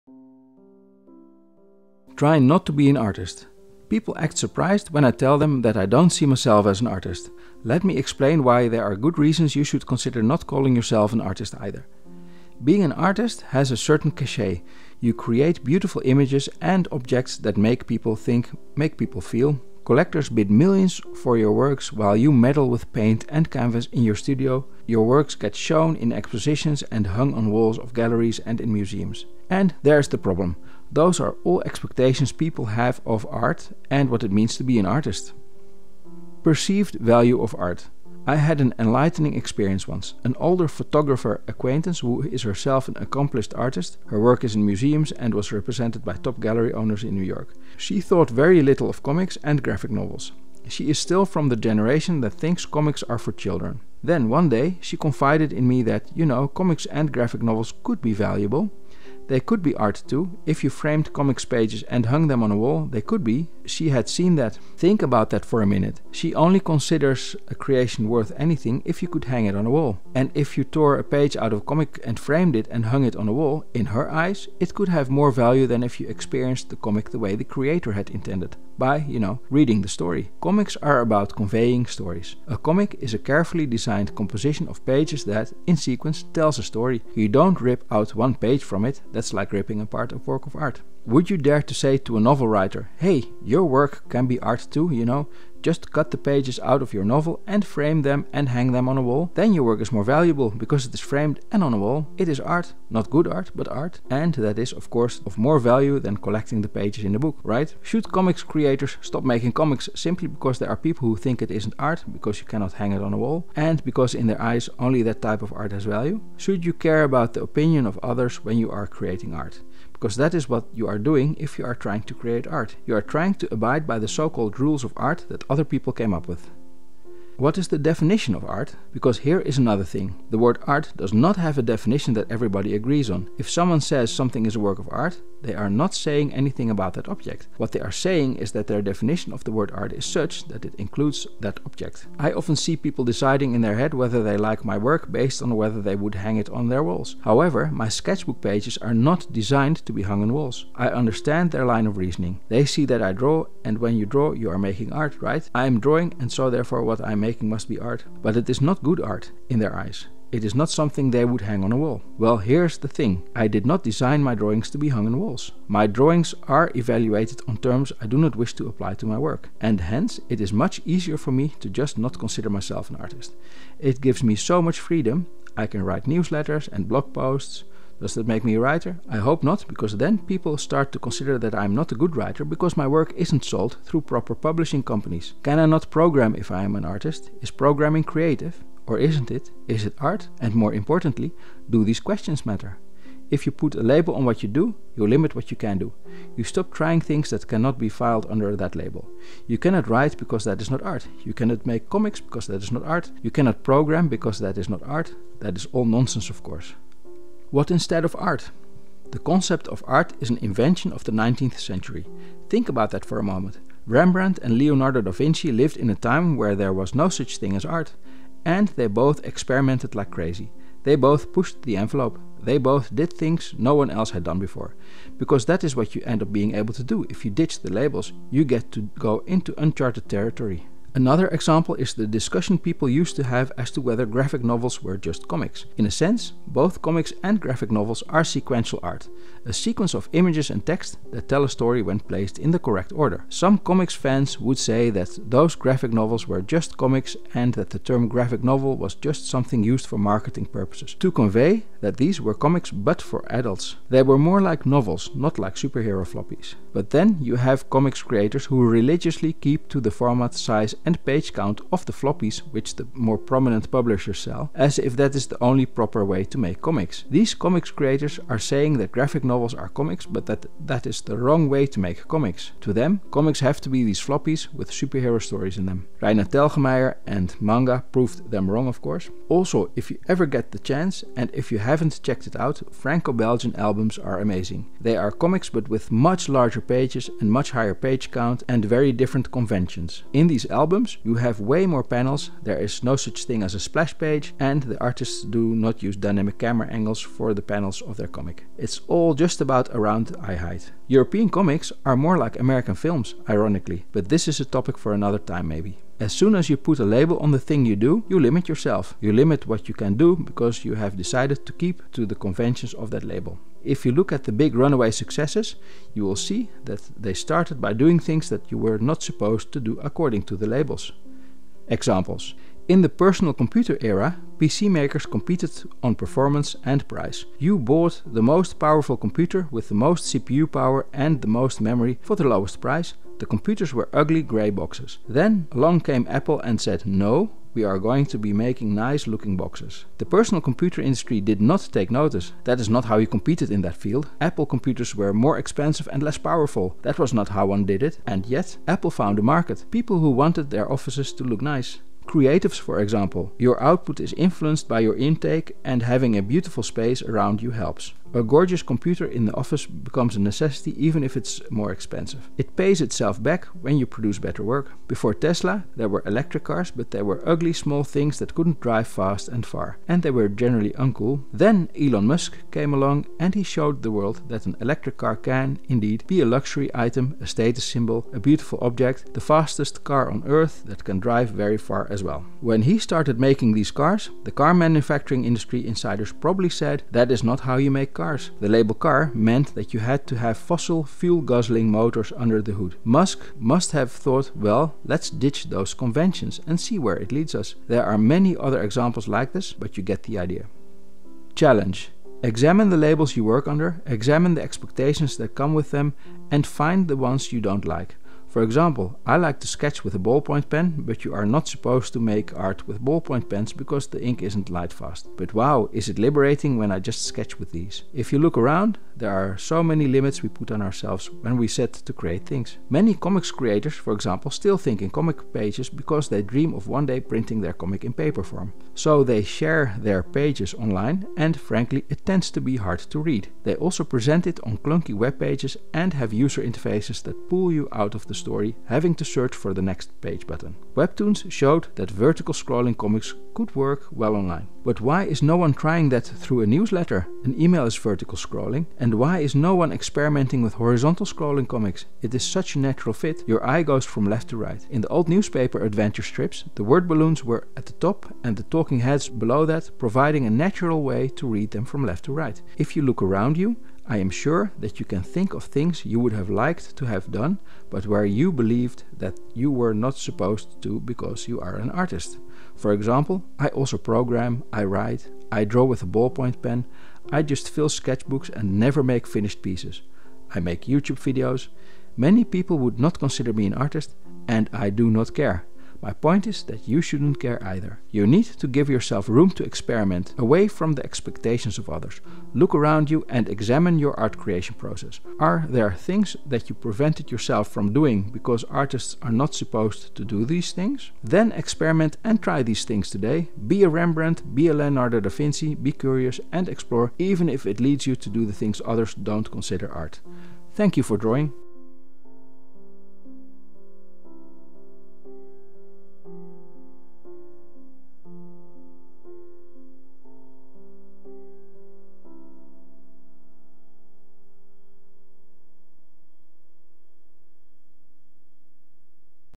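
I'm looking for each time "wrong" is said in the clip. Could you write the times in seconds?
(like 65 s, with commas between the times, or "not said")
271 s, 278 s.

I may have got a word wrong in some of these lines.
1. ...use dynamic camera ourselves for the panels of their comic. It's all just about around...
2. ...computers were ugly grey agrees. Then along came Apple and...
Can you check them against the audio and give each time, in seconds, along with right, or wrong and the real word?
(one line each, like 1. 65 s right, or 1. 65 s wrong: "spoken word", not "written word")
1. 295 s wrong: "angles", not "ourselves"
2. 333 s wrong: "boxes", not "agrees".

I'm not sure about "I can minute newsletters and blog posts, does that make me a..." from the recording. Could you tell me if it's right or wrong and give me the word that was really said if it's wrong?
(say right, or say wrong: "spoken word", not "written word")
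wrong: "write", not "minute".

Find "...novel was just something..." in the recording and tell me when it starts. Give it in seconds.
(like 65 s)
248 s.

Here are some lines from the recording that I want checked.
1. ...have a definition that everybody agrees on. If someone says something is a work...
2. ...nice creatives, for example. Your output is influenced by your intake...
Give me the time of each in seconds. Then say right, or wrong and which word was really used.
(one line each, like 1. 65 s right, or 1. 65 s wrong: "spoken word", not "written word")
1. 131 s right
2. 351 s right.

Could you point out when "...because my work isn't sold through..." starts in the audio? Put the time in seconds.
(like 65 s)
182 s.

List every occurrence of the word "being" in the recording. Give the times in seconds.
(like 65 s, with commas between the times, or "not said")
12 s, 226 s.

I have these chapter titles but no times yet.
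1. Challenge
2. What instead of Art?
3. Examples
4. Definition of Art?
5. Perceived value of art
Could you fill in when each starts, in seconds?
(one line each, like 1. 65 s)
1. 401 s
2. 207 s
3. 321 s
4. 127 s
5. 36 s.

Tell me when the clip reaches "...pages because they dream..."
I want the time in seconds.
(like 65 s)
425 s.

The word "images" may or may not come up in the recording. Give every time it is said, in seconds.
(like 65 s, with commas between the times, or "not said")
16 s, 240 s.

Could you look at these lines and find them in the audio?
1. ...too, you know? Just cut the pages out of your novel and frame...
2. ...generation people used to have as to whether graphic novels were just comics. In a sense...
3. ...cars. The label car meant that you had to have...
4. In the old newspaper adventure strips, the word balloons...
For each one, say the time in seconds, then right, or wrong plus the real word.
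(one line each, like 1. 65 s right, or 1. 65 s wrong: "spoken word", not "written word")
1. 94 s right
2. 232 s wrong: "discussion", not "generation"
3. 388 s right
4. 454 s right.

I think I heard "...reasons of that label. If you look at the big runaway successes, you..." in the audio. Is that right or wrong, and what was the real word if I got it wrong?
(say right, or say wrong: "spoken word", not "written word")
wrong: "conventions", not "reasons".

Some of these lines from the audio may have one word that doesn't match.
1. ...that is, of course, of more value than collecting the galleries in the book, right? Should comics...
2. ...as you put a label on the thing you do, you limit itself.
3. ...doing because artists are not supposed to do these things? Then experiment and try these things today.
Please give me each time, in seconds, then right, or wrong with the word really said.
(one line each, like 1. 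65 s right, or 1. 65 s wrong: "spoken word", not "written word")
1. 104 s wrong: "pages", not "galleries"
2. 306 s wrong: "yourself", not "itself"
3. 497 s right.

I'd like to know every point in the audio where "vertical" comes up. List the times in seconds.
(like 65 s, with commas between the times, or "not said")
442 s, 447 s.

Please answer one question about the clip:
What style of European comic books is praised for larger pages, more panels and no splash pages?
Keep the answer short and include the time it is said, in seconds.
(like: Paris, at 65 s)
Franco-Belgian albums, at 282 s.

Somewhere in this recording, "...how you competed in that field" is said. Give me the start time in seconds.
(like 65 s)
342 s.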